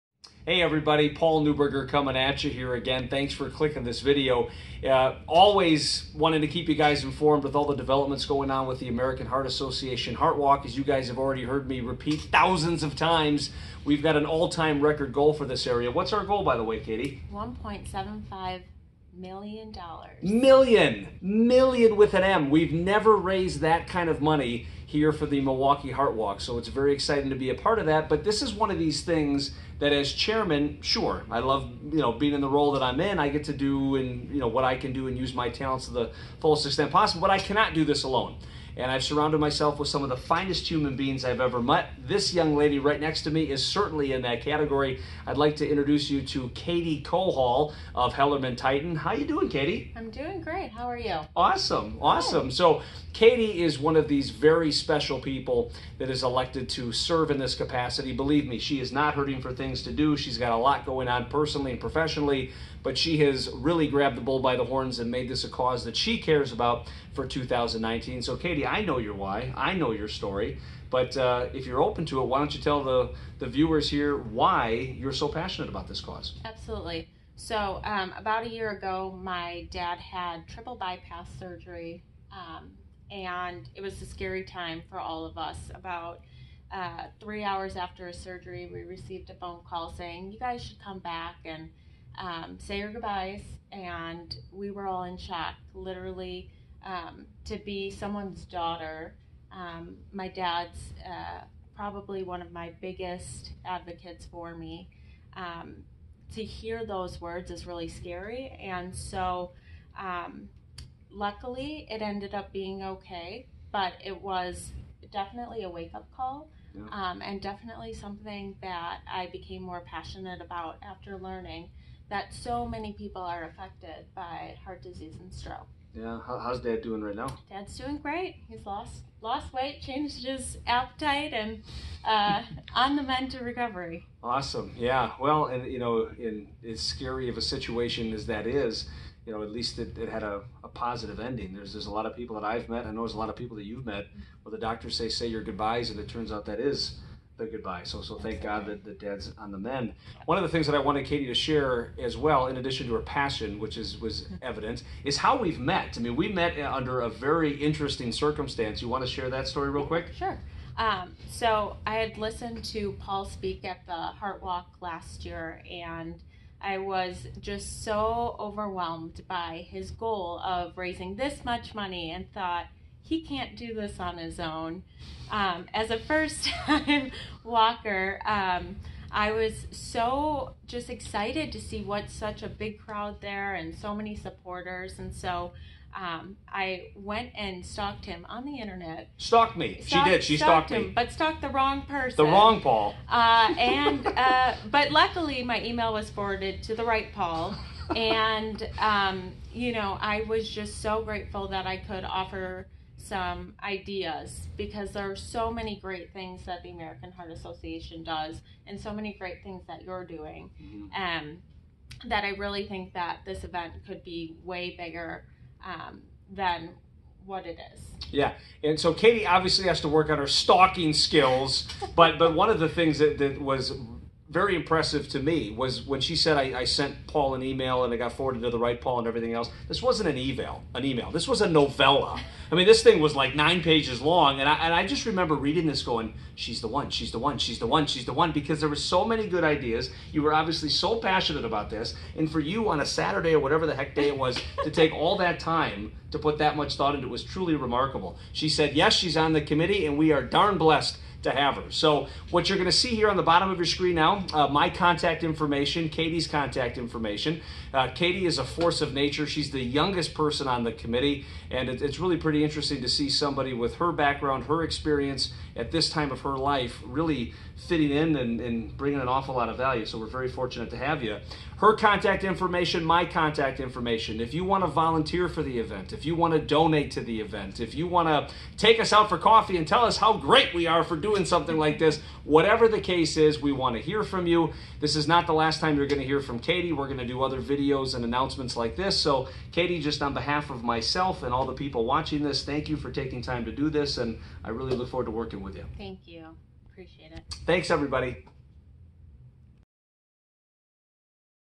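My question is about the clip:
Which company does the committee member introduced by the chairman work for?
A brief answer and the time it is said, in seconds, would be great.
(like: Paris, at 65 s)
HellermannTyton, at 48 s.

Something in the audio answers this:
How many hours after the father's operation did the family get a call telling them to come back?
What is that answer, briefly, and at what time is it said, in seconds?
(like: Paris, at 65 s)
3, at 87 s.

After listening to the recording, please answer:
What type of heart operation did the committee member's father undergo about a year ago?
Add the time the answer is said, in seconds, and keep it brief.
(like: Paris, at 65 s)
Triple bypass surgery, at 80 s.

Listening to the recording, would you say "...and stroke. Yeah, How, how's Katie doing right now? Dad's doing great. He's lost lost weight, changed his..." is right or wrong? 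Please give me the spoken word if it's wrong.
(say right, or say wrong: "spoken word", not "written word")
wrong: "Dad", not "Katie".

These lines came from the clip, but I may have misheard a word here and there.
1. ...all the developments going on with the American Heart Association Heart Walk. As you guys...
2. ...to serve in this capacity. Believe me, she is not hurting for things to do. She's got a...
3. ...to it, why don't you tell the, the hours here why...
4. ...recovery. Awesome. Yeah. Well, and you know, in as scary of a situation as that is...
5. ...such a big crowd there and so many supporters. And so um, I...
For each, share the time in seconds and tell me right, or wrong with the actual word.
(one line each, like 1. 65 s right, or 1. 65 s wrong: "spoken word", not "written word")
1. 7 s right
2. 56 s right
3. 72 s wrong: "viewers", not "hours"
4. 133 s right
5. 182 s right.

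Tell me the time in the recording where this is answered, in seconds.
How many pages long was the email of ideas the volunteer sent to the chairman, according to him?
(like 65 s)
233 s.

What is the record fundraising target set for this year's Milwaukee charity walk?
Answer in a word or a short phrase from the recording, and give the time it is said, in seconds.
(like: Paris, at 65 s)
$1.75 million, at 17 s.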